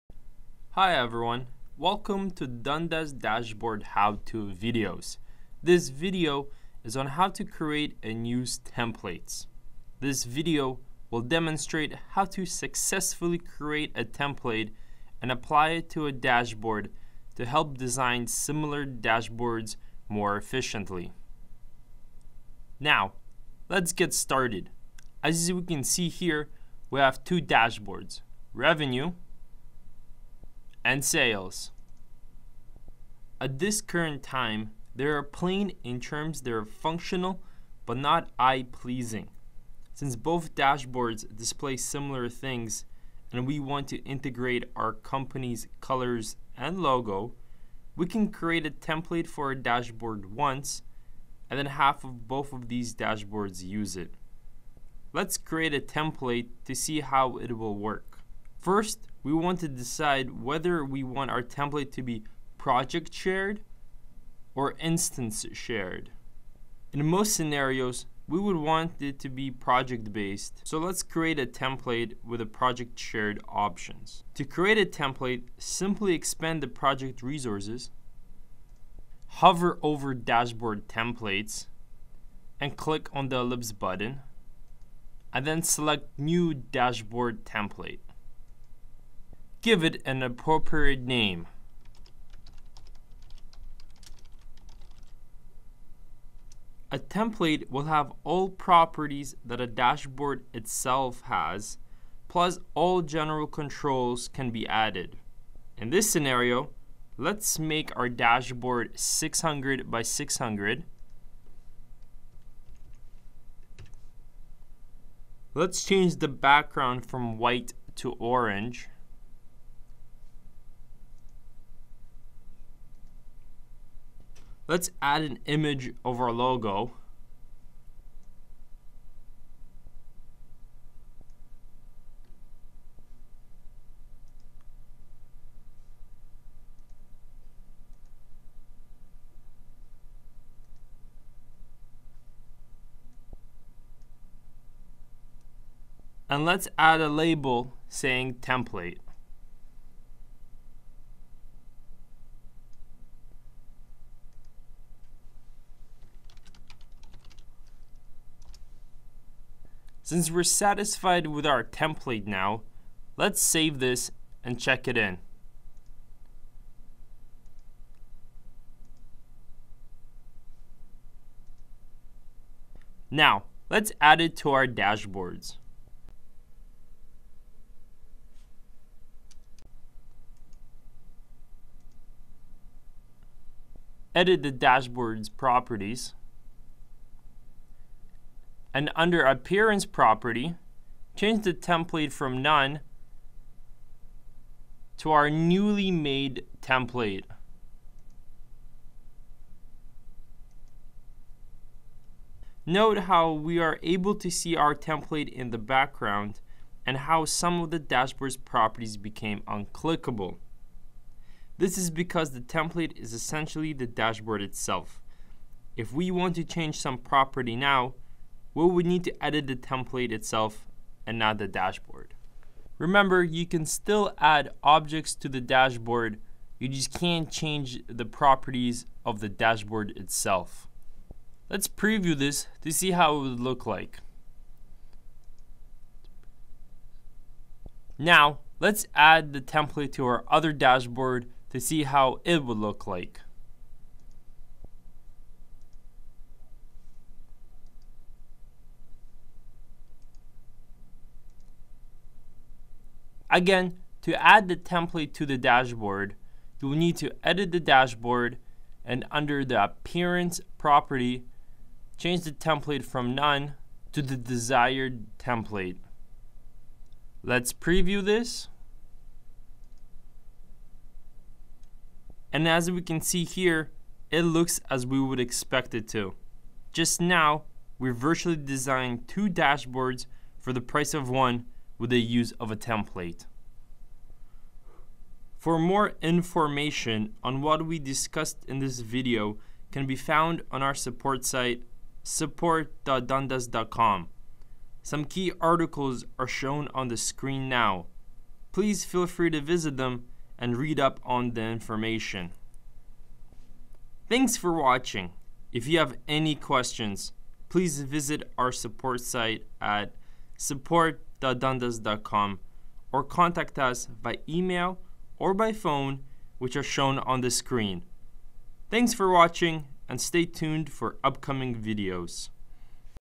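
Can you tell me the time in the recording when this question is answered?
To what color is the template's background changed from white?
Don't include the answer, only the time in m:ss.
1:58.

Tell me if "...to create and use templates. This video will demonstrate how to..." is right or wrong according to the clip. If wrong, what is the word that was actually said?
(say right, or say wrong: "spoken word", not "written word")
right.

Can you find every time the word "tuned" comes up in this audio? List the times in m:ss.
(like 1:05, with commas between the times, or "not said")
5:20.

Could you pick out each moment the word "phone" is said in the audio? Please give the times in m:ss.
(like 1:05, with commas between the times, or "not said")
5:15.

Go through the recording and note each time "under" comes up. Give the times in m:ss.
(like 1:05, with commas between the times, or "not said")
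3:08, 4:19.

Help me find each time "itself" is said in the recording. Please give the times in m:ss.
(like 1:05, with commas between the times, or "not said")
1:40, 3:34, 3:40, 3:49.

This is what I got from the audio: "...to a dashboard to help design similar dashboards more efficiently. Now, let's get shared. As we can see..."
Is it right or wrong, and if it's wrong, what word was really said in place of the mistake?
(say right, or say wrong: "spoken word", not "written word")
wrong: "started", not "shared".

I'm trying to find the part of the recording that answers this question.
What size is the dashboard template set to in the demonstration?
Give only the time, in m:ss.
1:48.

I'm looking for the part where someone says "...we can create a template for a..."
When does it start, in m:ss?
0:47.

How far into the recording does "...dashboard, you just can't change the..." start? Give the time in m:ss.
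3:45.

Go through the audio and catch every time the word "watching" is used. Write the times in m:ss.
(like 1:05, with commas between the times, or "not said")
5:04, 5:19.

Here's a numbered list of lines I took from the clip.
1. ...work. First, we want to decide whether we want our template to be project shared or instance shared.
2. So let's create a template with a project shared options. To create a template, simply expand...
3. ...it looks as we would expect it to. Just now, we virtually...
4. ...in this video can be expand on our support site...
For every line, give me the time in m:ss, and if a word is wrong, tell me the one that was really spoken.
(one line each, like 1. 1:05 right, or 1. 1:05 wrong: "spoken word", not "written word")
1. 0:57 right
2. 1:10 right
3. 4:34 right
4. 4:48 wrong: "found", not "expand".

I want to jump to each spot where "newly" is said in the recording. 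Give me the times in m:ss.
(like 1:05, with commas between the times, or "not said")
3:15.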